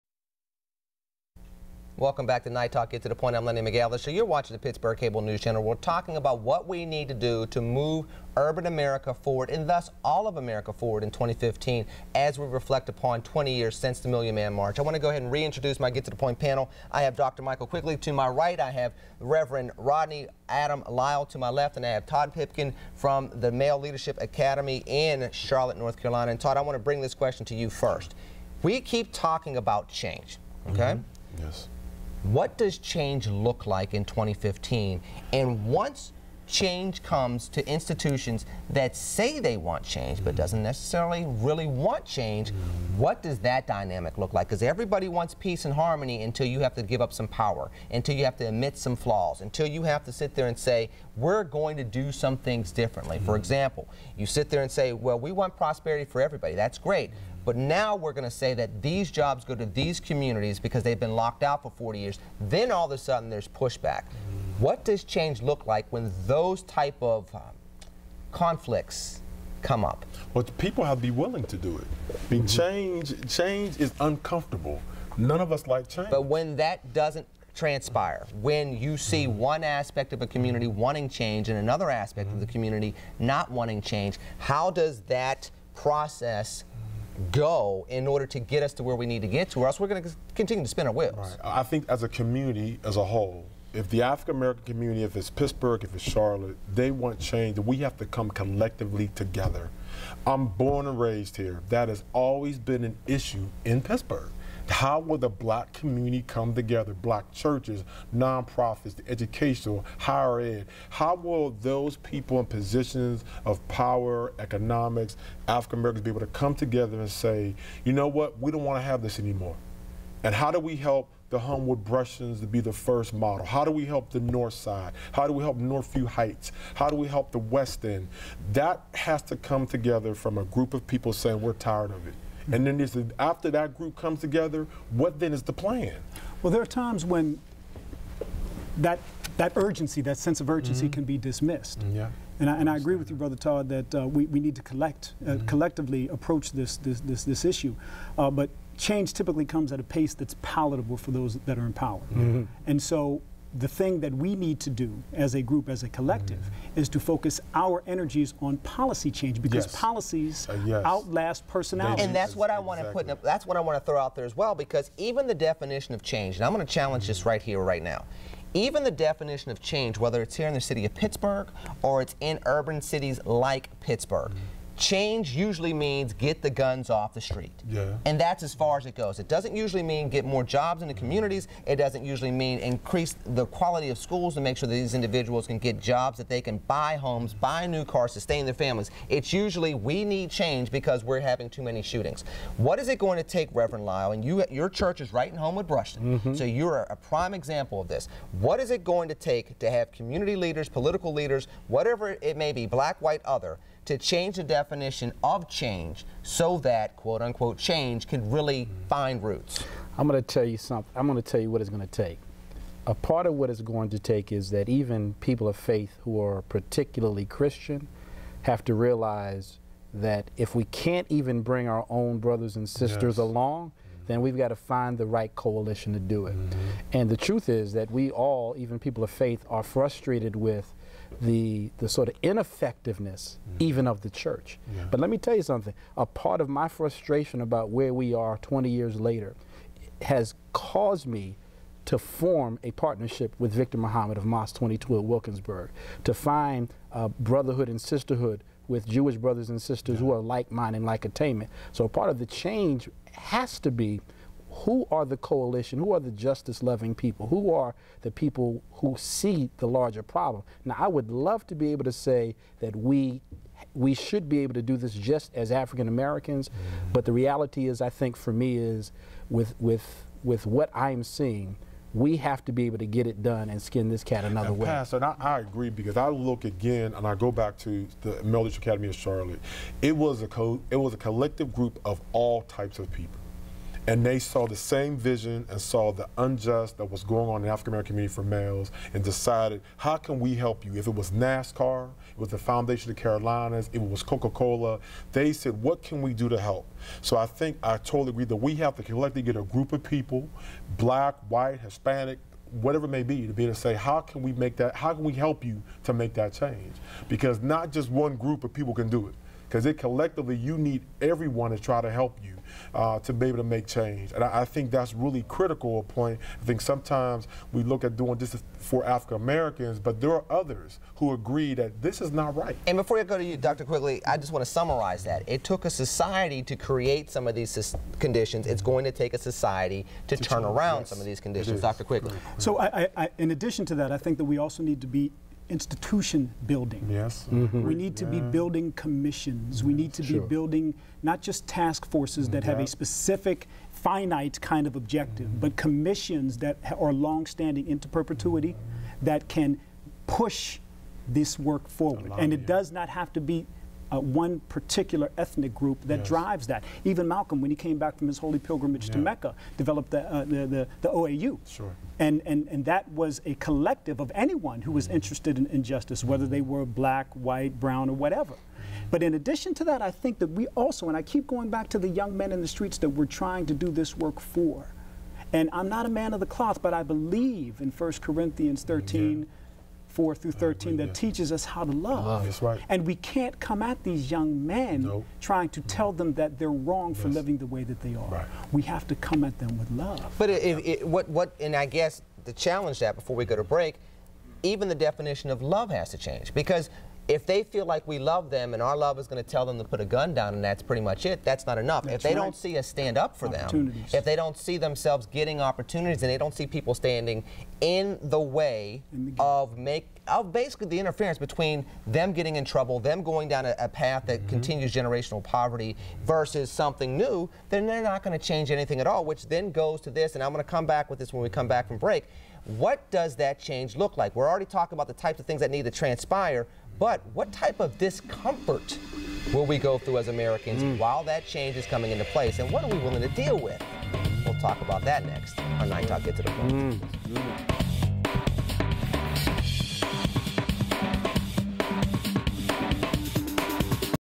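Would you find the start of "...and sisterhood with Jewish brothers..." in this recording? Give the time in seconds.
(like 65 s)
247 s.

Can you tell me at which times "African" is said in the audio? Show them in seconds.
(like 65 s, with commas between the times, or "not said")
94 s, 115 s, 265 s, 287 s, 318 s.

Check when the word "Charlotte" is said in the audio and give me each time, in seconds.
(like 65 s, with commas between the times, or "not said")
25 s, 96 s, 278 s.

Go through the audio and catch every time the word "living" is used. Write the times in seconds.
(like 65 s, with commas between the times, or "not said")
387 s.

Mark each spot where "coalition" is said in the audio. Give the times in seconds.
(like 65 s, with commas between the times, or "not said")
225 s, 255 s.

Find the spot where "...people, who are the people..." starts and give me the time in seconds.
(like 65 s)
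256 s.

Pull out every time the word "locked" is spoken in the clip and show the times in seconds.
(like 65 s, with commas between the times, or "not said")
61 s.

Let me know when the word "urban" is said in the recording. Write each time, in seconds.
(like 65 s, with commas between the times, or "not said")
8 s, 172 s.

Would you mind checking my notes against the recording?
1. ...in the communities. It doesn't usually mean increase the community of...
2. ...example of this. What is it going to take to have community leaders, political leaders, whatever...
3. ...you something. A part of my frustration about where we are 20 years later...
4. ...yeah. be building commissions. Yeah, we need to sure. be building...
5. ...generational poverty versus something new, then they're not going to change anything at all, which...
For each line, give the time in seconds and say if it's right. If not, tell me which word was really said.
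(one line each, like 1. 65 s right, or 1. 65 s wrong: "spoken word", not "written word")
1. 180 s wrong: "quality", not "community"
2. 197 s right
3. 235 s right
4. 338 s right
5. 414 s right.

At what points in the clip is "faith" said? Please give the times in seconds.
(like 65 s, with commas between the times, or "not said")
215 s, 229 s.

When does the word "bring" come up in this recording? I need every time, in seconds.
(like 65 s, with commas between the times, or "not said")
26 s, 221 s.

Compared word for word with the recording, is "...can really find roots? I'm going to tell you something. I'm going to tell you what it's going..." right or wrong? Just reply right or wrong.
right.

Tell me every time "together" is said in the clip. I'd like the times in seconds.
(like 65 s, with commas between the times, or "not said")
99 s, 106 s, 116 s, 129 s, 134 s.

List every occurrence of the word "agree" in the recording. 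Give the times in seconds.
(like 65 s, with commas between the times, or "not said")
142 s, 275 s, 298 s, 321 s.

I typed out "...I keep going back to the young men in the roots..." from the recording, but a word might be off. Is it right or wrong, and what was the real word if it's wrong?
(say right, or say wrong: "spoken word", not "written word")
wrong: "streets", not "roots".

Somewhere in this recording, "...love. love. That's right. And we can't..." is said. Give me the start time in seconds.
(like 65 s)
381 s.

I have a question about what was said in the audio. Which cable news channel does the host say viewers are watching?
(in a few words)
Pittsburgh Cable News Channel.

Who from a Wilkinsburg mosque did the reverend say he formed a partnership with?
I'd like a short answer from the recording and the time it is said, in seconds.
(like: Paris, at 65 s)
Victor Muhammad, at 243 s.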